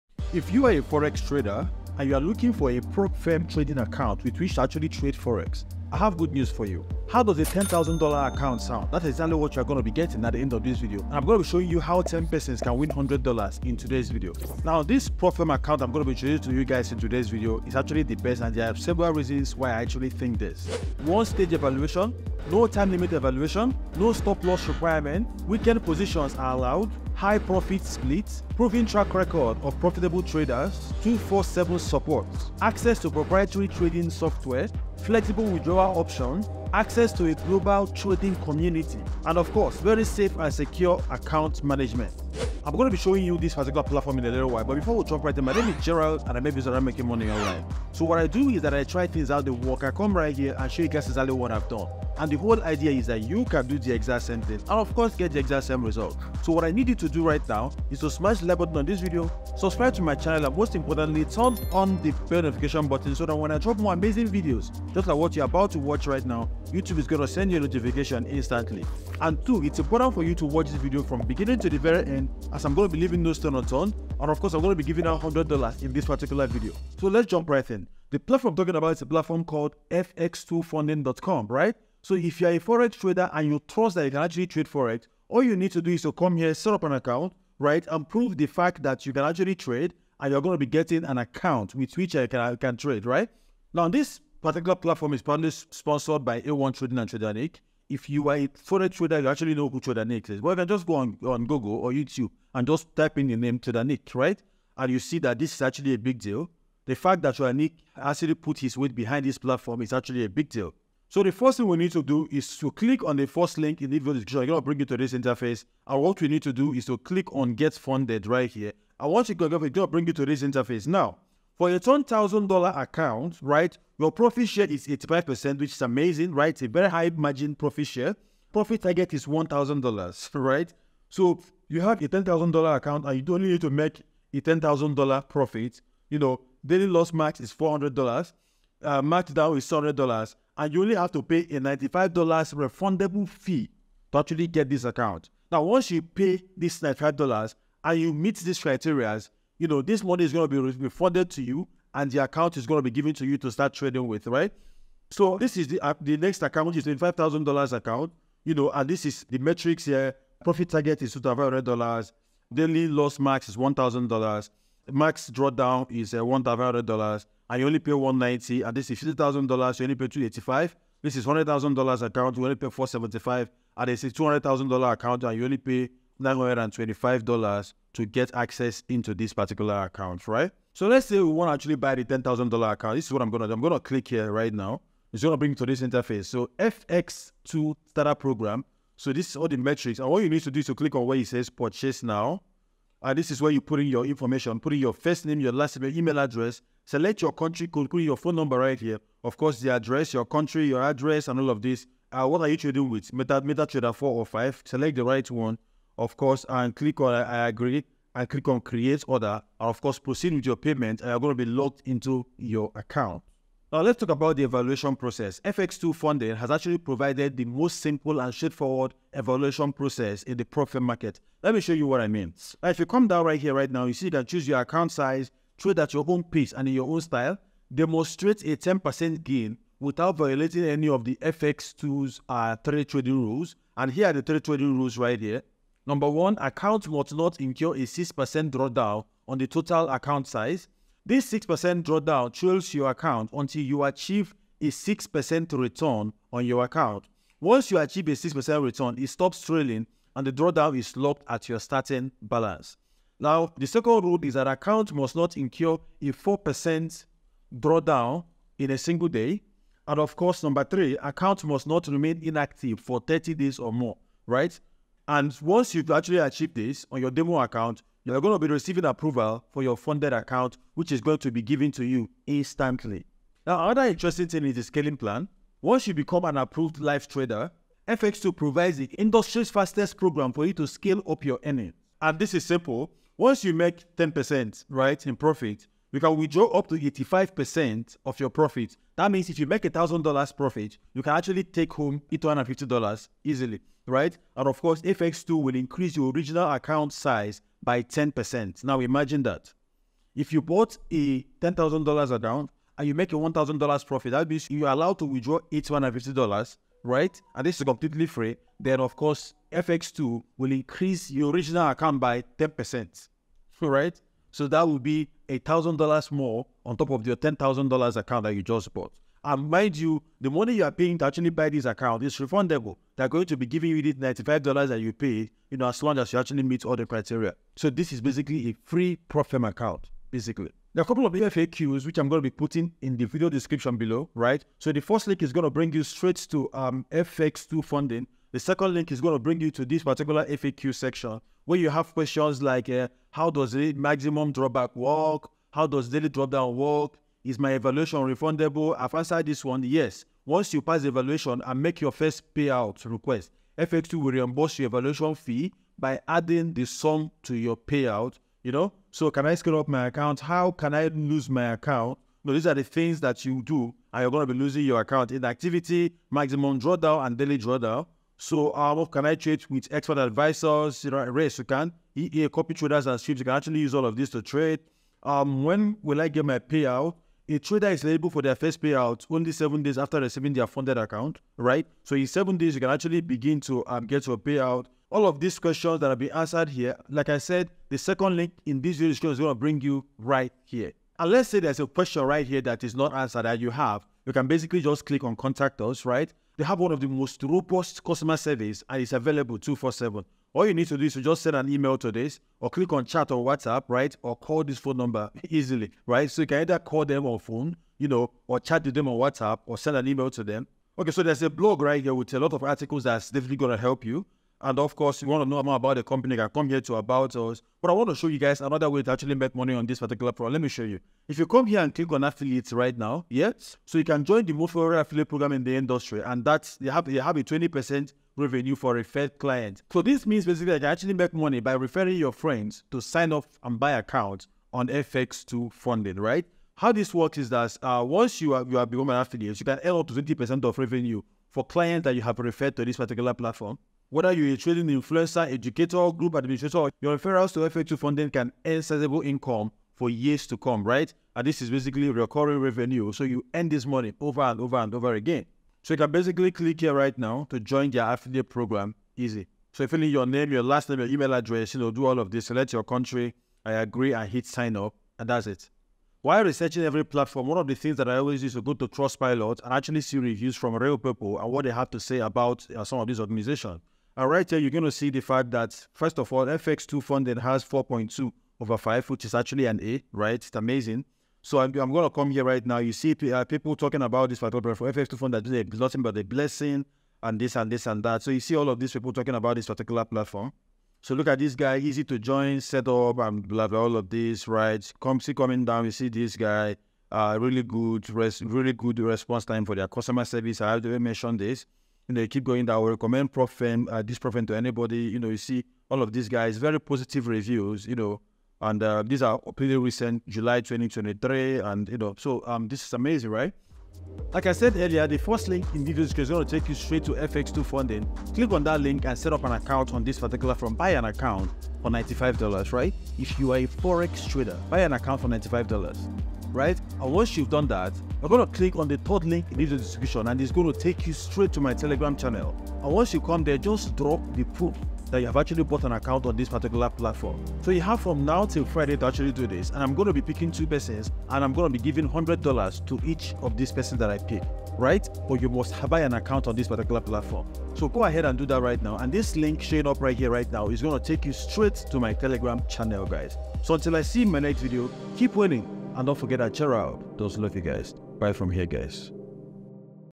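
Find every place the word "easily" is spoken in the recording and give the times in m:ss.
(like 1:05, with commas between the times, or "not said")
4:53, 6:45.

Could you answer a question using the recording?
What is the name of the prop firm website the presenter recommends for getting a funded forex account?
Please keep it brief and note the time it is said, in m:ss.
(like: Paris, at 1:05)
fx2funding.com, at 1:19.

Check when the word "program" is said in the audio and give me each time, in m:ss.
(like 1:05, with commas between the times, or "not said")
3:08, 4:39, 7:00, 7:05, 7:38.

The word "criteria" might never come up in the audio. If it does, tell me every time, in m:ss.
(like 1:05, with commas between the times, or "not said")
2:28, 5:26.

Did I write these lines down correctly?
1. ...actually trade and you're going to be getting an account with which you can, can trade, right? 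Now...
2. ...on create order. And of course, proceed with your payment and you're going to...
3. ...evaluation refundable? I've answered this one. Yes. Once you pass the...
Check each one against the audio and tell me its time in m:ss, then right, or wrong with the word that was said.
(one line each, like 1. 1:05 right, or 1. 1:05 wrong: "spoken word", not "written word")
1. 1:29 right
2. 3:28 right
3. 5:47 right.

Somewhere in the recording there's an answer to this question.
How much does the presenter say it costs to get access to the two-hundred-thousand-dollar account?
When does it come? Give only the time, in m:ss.
2:56.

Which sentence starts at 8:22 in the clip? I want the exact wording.
We recommend Profen, uh, this Prof to anybody.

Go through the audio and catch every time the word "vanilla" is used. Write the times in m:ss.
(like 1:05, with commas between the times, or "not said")
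not said.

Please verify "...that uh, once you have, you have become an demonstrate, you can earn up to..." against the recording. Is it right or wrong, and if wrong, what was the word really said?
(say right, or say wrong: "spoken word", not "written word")
wrong: "affiliate", not "demonstrate".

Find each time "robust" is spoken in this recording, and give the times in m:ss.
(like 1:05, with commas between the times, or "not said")
6:37.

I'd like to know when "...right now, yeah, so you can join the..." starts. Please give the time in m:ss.
7:02.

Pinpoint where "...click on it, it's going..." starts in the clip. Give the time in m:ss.
1:59.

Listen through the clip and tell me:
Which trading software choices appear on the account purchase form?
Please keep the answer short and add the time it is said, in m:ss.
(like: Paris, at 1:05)
MetaTrader 4 or 5, at 3:23.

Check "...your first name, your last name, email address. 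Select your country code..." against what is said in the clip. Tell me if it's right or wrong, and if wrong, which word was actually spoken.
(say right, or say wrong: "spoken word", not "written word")
right.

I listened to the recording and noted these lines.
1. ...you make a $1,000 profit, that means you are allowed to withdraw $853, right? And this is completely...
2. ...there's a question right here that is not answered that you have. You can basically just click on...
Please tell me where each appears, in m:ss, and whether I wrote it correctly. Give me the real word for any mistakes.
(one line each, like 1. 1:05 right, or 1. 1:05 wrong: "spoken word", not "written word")
1. 5:02 wrong: "850", not "853"
2. 6:31 right.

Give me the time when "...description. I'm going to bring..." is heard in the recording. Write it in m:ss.
1:54.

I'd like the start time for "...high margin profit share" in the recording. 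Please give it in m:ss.
2:06.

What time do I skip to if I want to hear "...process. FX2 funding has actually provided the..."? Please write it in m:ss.
3:34.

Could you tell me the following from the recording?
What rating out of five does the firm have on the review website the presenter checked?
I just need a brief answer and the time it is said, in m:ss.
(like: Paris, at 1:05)
4.2, at 7:57.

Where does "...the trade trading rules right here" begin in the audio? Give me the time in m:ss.
3:54.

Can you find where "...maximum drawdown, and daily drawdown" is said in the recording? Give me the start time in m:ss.
6:06.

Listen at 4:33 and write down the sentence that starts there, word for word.
Now, another interesting thing is the scaling plan.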